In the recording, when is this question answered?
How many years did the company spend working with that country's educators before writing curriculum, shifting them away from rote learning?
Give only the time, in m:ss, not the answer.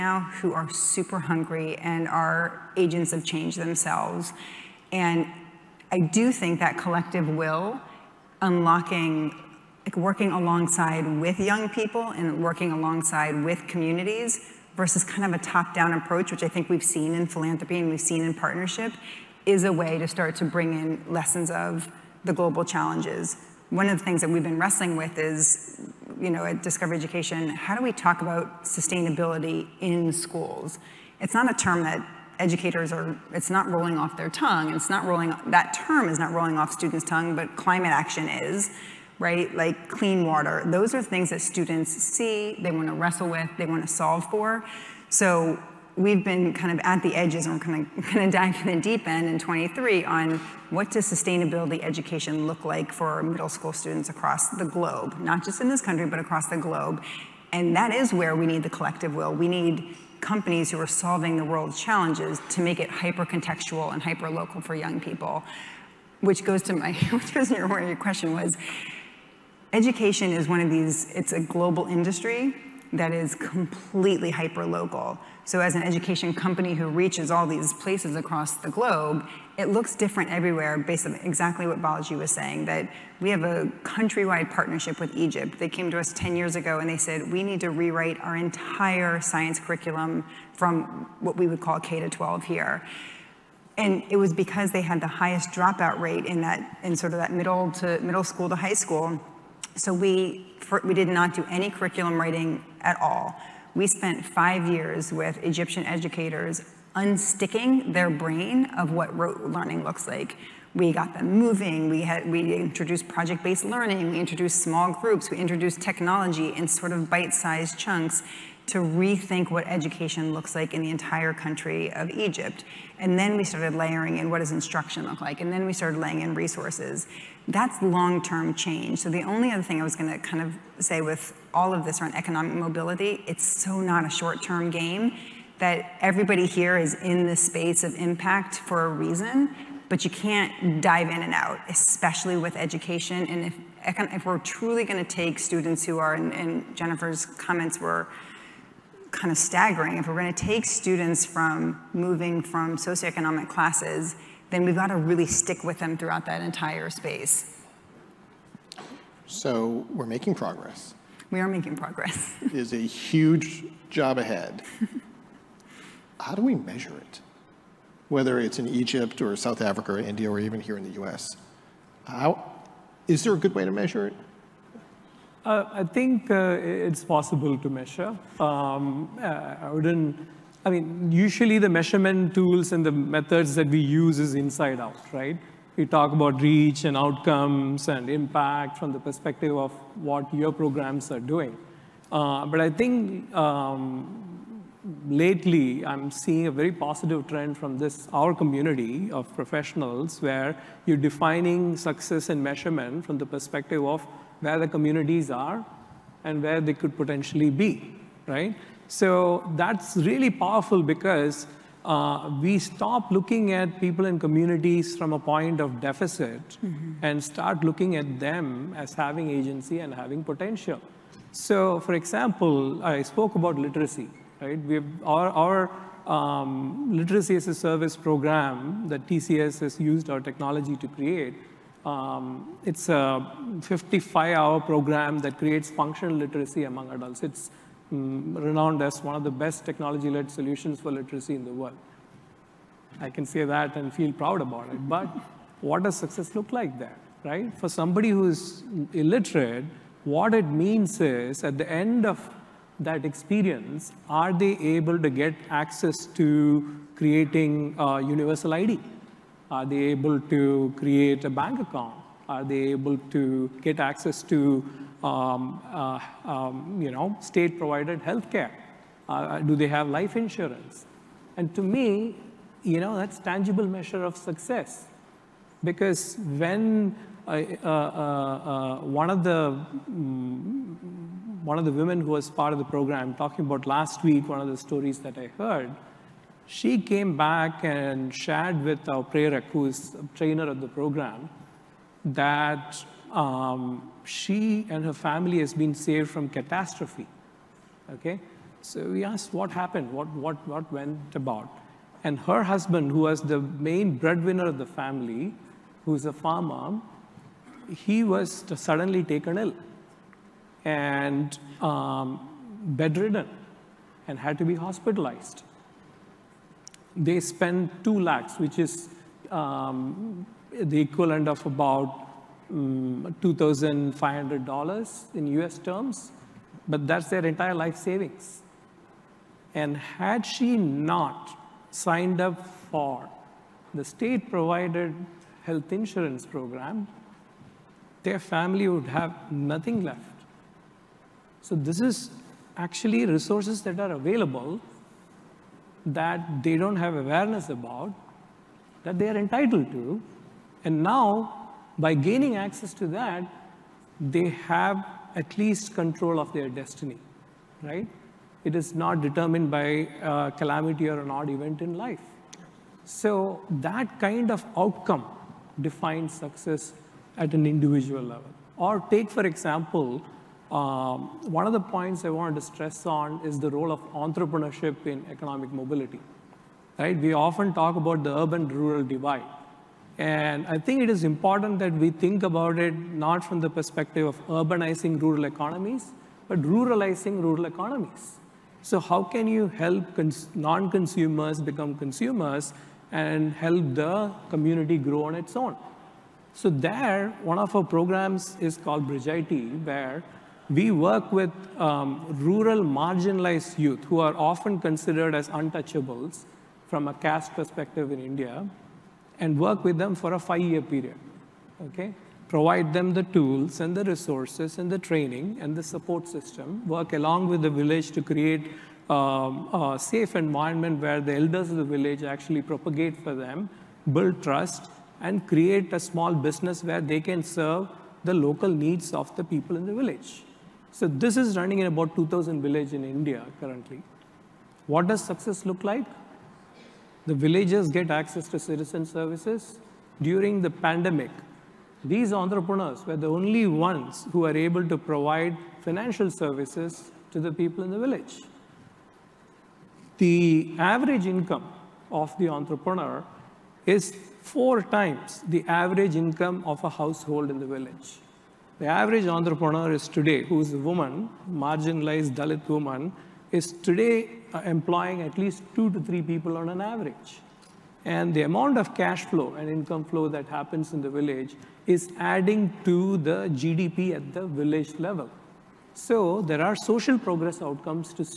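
1:44.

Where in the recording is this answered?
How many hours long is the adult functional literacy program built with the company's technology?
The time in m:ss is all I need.
3:53.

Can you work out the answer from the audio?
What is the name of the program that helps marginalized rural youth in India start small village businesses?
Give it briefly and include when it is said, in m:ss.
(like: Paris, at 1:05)
Bridge IT, at 6:38.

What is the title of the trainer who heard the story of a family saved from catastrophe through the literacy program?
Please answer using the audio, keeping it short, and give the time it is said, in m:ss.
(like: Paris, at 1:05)
Prerak, at 4:49.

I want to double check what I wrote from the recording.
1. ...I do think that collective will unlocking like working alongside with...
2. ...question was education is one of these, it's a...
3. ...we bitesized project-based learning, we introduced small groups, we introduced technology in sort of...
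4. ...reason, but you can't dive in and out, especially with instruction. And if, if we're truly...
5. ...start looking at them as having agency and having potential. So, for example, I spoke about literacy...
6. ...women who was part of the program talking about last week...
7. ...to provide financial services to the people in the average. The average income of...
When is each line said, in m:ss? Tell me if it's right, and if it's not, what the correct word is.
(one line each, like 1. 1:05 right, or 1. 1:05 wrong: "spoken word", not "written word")
1. 0:05 right
2. 1:07 right
3. 1:52 wrong: "introduced", not "bitesized"
4. 2:18 wrong: "education", not "instruction"
5. 3:37 right
6. 4:41 right
7. 7:24 wrong: "village", not "average".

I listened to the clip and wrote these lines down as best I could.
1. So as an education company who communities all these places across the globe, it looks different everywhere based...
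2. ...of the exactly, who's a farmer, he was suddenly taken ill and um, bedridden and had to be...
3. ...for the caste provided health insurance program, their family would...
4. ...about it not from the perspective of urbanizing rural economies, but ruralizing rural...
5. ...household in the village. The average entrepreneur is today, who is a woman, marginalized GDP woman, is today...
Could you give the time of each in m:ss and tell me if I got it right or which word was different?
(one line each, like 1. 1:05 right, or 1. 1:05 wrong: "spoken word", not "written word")
1. 1:15 wrong: "reaches", not "communities"
2. 5:04 wrong: "family", not "exactly"
3. 5:32 wrong: "state", not "caste"
4. 6:22 right
5. 7:36 wrong: "Dalit", not "GDP".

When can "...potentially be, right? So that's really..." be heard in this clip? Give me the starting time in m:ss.
3:26.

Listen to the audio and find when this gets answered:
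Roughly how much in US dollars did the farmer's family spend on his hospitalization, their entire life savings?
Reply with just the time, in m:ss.
5:23.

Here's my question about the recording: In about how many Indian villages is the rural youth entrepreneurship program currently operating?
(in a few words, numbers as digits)
2,000.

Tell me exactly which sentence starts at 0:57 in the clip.
And that is where we need the collective will.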